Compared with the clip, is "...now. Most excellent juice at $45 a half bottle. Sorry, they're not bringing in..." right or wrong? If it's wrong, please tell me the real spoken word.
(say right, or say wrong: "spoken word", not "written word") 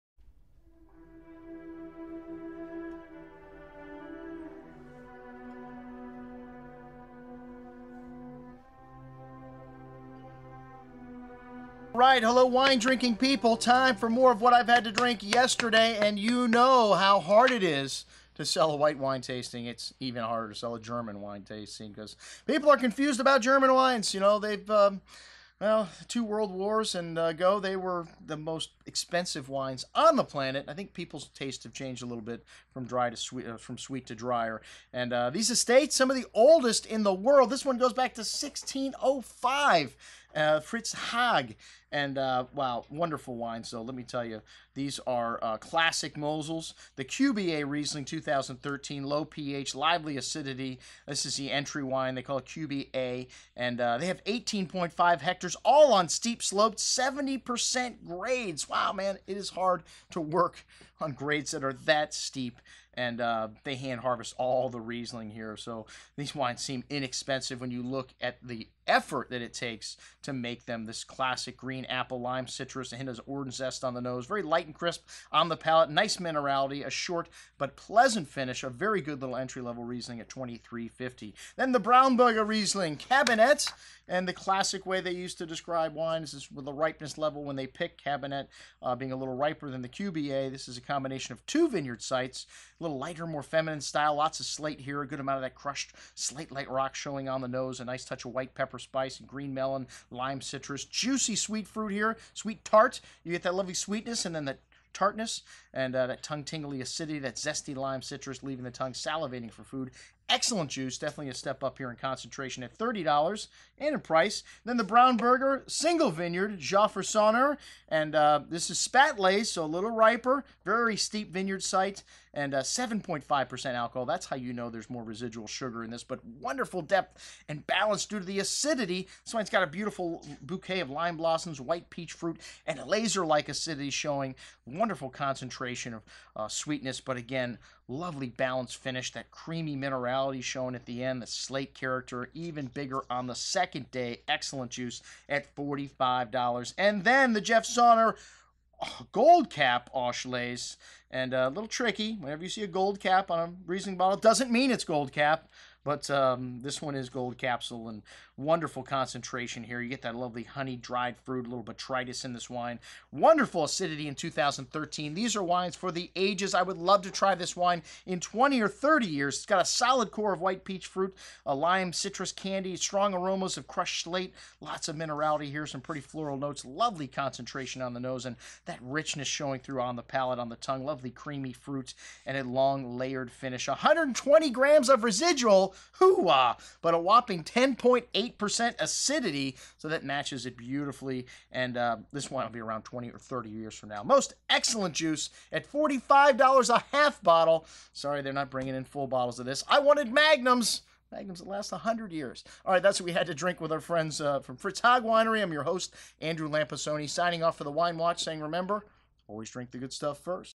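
right.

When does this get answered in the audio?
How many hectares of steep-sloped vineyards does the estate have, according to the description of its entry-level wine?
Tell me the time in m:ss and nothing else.
0:54.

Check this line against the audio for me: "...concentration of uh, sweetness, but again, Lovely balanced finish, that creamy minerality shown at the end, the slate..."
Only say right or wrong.
right.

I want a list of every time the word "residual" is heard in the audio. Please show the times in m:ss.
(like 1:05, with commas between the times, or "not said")
2:05, 3:05.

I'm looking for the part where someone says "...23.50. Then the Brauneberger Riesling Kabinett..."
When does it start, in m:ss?
1:20.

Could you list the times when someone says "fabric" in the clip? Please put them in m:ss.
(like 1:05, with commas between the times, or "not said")
not said.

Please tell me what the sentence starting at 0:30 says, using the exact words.
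I think people's tastes have changed a little bit from dry to sweet, uh, from sweet to drier.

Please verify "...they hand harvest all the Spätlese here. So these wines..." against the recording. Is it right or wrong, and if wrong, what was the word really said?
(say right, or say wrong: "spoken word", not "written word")
wrong: "Riesling", not "Spätlese".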